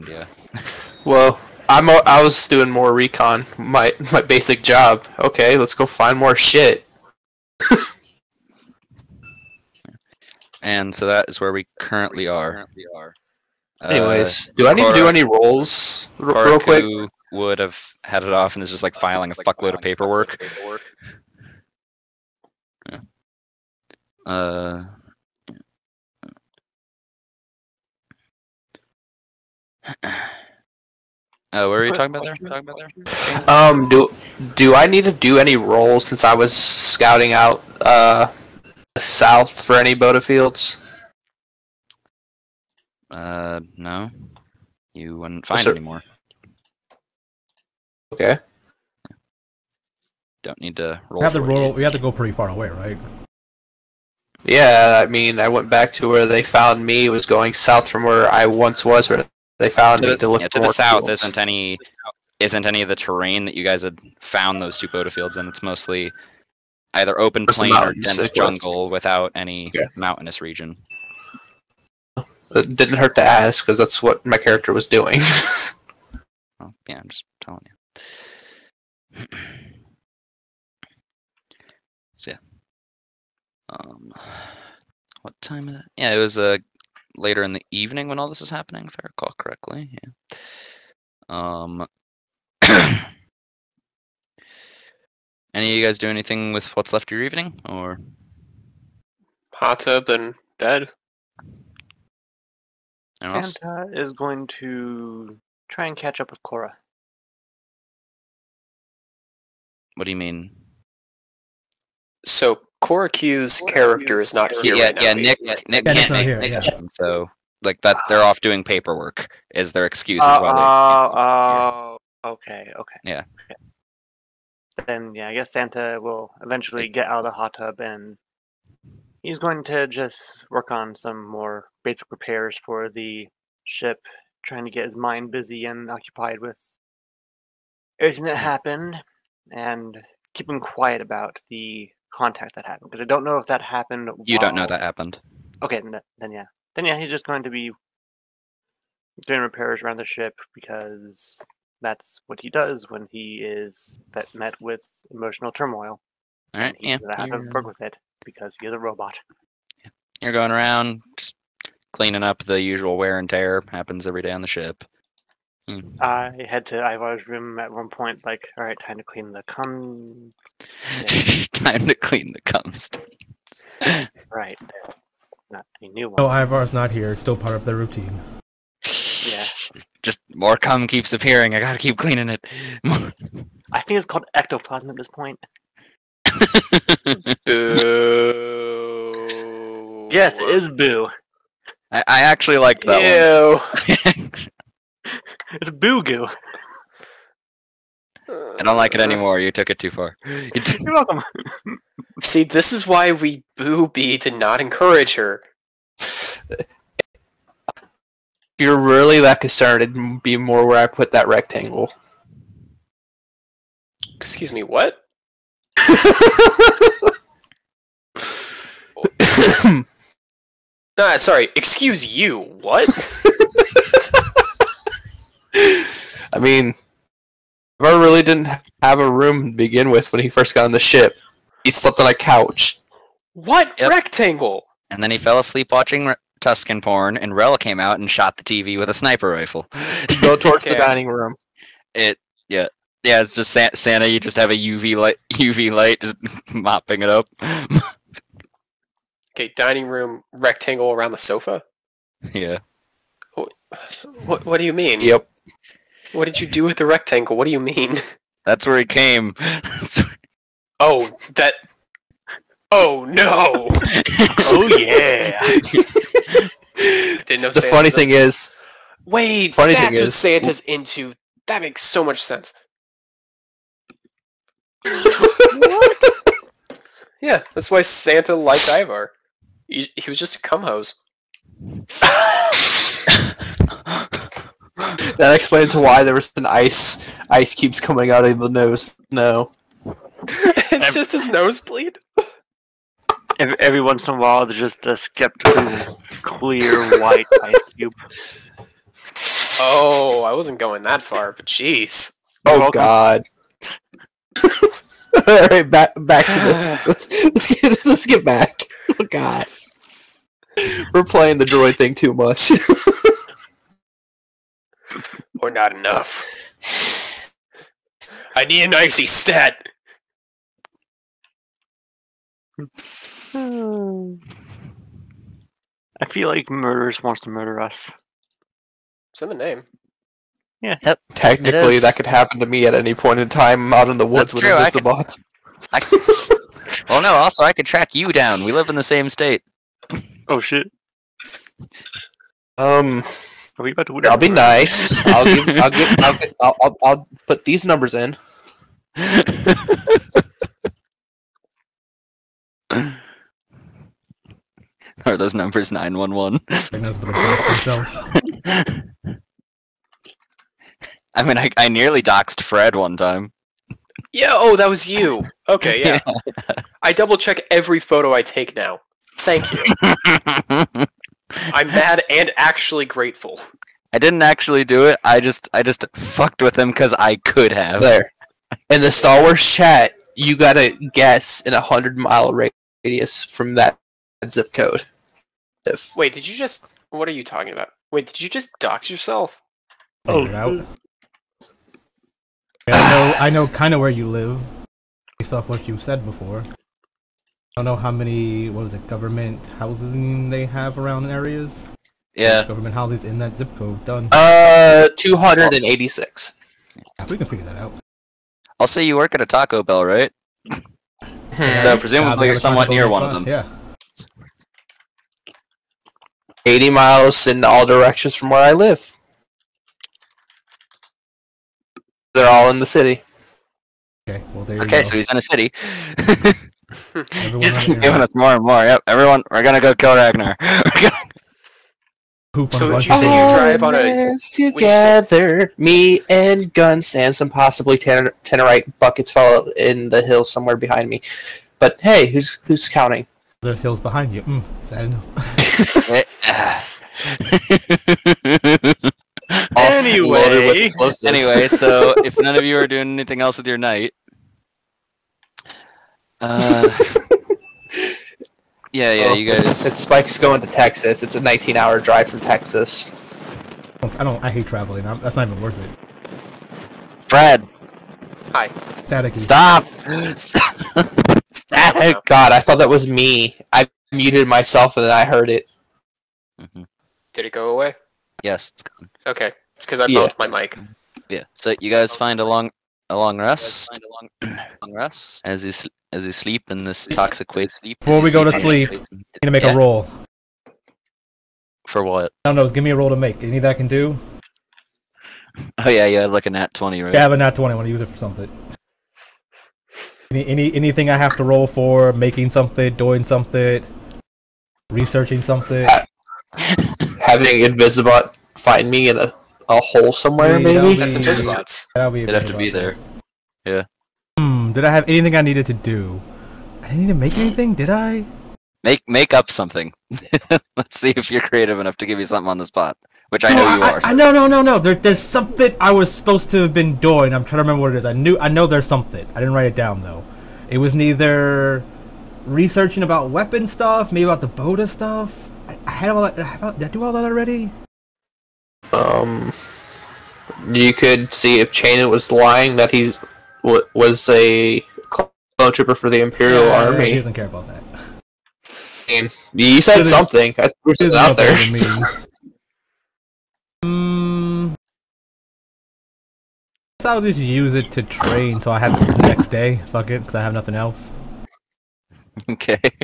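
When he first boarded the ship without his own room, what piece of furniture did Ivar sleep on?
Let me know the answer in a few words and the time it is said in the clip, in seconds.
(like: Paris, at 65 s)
a couch, at 232 s.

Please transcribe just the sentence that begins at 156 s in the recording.
All right, he's yeah, have to work with it because he's a robot.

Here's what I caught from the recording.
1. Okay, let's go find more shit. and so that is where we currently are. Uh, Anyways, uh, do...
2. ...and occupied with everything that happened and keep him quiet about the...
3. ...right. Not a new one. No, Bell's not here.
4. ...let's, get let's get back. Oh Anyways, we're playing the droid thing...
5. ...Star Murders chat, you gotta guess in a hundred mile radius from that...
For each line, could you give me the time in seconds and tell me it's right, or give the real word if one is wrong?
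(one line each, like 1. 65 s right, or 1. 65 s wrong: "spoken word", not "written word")
1. 5 s right
2. 135 s right
3. 174 s wrong: "Ivar", not "Bell"
4. 307 s wrong: "God", not "Anyways"
5. 378 s wrong: "Wars", not "Murders".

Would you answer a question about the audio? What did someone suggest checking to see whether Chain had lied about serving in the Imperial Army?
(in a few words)
a clone trooper.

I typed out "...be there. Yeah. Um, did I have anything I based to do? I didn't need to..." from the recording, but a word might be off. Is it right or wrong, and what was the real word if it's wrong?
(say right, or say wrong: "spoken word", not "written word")
wrong: "needed", not "based".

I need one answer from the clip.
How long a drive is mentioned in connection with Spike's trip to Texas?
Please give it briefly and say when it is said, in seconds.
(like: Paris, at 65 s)
19 hours, at 461 s.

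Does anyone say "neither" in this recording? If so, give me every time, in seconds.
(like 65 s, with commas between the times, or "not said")
530 s.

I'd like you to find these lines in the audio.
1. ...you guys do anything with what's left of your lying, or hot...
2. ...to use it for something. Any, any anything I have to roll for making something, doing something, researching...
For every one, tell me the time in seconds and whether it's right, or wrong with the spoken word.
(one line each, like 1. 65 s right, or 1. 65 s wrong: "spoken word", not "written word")
1. 95 s wrong: "evening", not "lying"
2. 497 s right.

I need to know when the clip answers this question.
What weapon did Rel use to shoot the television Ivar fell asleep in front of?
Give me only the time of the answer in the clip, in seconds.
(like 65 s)
238 s.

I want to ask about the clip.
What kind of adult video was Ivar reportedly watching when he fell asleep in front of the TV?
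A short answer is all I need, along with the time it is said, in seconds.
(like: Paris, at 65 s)
Tusken porn, at 236 s.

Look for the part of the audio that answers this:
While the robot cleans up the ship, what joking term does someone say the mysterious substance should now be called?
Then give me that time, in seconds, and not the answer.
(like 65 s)
184 s.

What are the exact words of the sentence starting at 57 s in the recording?
was going south from where I once was, where they found to, it.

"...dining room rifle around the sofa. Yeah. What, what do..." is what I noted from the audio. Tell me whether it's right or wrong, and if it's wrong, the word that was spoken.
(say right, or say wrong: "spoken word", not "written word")
wrong: "rectangle", not "rifle".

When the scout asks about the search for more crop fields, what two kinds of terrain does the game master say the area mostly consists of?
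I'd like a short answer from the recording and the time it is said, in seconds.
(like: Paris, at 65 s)
open plain or dense jungle, at 67 s.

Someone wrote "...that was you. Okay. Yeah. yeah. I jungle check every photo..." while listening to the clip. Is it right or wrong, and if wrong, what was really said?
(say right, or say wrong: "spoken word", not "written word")
wrong: "double", not "jungle".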